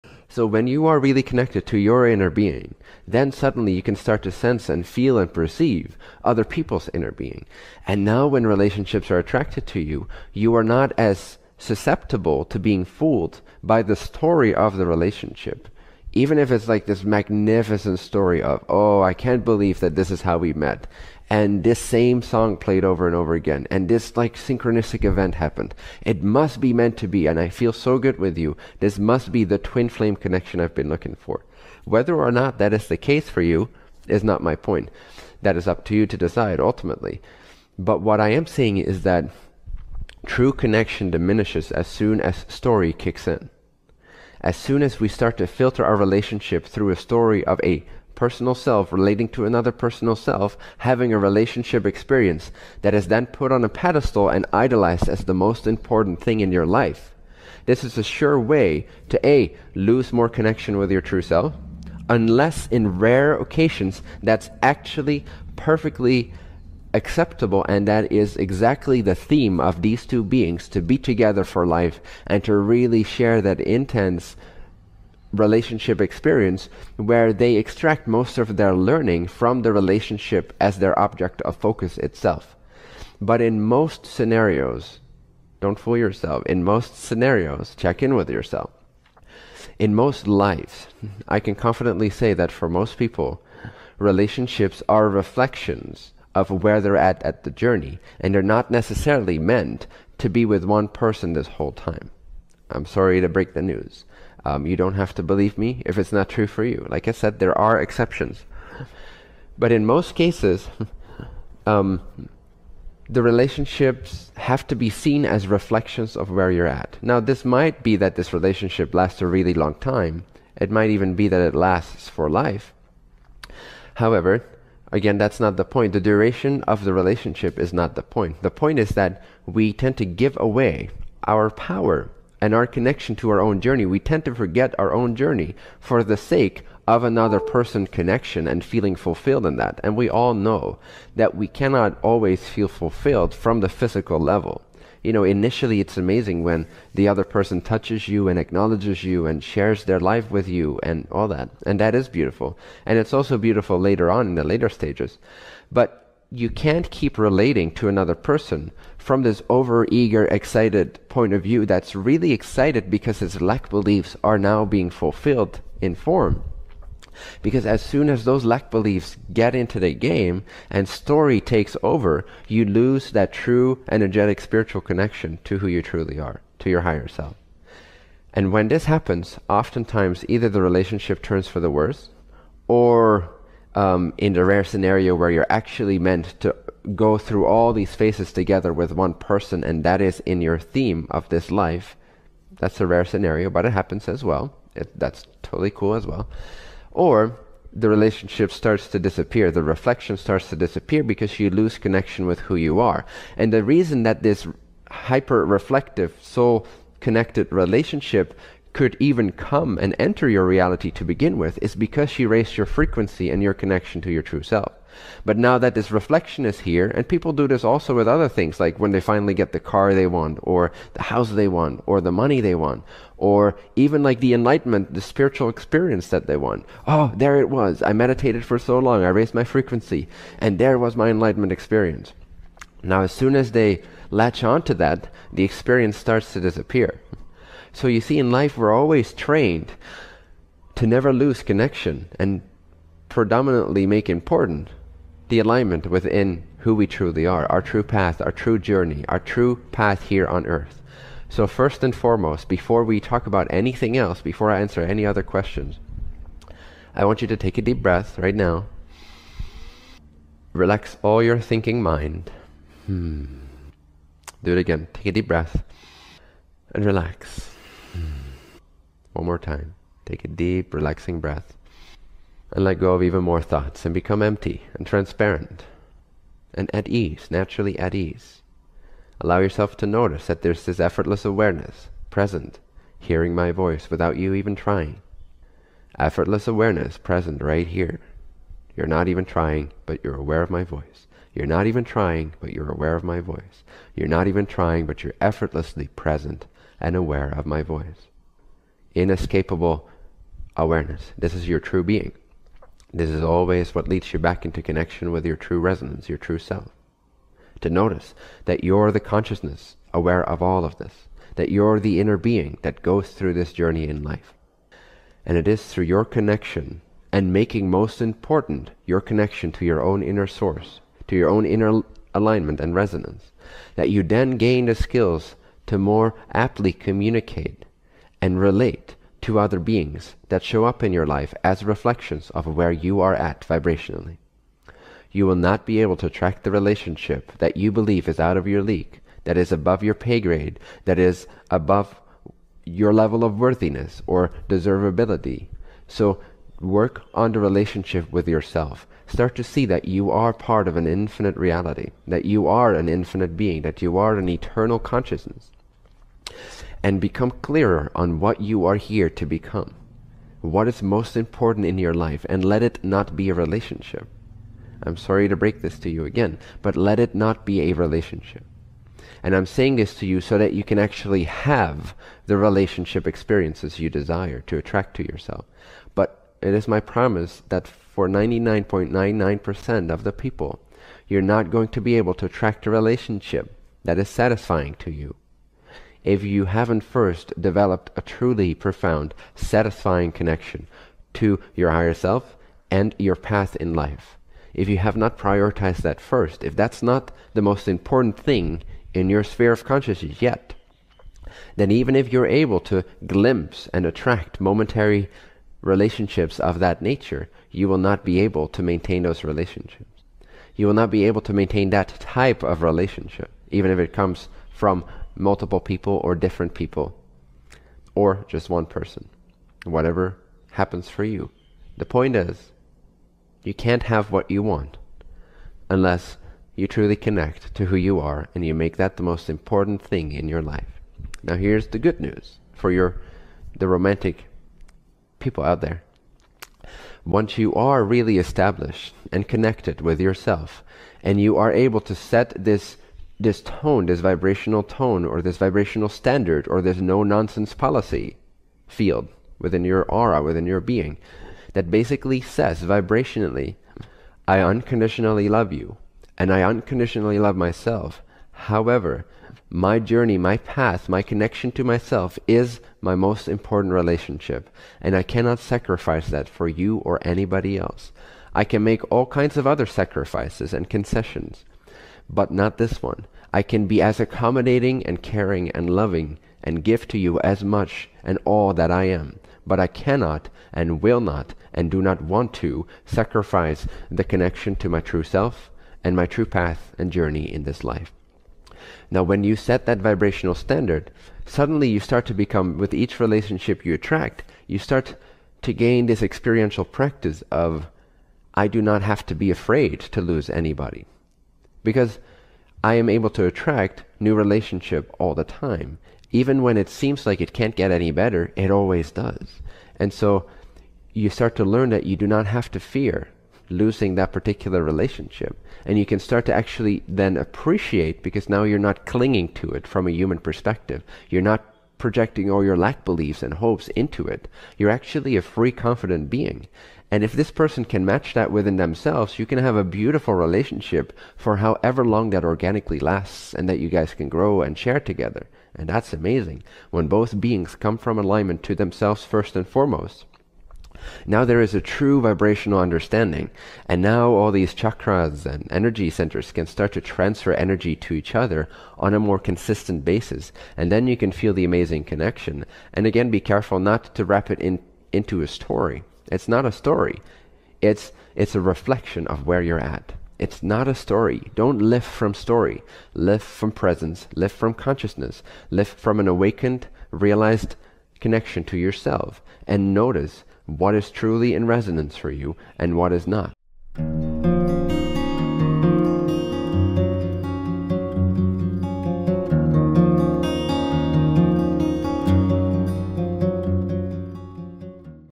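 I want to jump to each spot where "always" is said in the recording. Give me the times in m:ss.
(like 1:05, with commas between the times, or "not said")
2:22, 3:58, 5:03, 8:28.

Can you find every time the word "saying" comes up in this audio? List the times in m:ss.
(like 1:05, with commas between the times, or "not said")
0:38, 6:09.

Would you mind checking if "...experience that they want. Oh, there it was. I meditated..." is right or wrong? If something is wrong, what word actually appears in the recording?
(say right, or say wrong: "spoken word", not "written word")
right.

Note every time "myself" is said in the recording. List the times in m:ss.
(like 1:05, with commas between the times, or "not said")
7:37, 7:41.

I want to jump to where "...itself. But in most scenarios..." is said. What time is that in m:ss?
1:21.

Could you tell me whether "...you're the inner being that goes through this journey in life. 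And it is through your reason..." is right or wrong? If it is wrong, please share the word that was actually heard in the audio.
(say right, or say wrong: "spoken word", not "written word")
wrong: "connection", not "reason".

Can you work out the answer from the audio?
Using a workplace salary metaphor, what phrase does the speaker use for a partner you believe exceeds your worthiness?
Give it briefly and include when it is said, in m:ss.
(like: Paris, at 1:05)
above your pay grade, at 5:39.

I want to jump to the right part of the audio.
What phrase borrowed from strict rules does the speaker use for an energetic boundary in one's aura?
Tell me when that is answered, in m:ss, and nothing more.
7:26.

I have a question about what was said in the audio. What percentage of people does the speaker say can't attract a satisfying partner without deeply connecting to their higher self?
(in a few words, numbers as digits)
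99.99%.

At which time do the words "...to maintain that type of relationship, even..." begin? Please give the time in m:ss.
6:51.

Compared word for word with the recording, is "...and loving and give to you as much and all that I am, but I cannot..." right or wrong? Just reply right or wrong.
right.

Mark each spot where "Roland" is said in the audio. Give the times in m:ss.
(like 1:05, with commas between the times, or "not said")
not said.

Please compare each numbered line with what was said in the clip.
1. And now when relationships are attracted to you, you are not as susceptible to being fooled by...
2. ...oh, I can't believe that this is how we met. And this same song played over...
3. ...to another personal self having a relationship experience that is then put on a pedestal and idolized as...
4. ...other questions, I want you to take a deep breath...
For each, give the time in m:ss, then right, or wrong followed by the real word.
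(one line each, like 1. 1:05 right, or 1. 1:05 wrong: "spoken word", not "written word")
1. 0:07 right
2. 0:18 right
3. 0:49 right
4. 4:15 right.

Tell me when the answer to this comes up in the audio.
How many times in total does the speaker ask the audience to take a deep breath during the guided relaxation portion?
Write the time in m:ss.
4:29.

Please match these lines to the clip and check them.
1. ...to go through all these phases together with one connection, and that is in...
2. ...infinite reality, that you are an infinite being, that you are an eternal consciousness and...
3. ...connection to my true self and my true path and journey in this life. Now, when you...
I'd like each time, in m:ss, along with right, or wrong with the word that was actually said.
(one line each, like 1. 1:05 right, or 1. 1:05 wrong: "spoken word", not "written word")
1. 3:06 wrong: "person", not "connection"
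2. 5:50 right
3. 8:04 right.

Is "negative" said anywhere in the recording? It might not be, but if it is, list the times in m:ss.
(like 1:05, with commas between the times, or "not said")
not said.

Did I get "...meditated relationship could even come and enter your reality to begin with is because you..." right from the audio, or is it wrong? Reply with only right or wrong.
wrong.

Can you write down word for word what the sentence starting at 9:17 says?
It's it's a reflection of where you're at.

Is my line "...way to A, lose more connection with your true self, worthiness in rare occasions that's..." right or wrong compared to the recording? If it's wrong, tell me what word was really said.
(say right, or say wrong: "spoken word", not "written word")
wrong: "unless", not "worthiness".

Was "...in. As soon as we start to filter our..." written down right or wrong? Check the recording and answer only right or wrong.
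right.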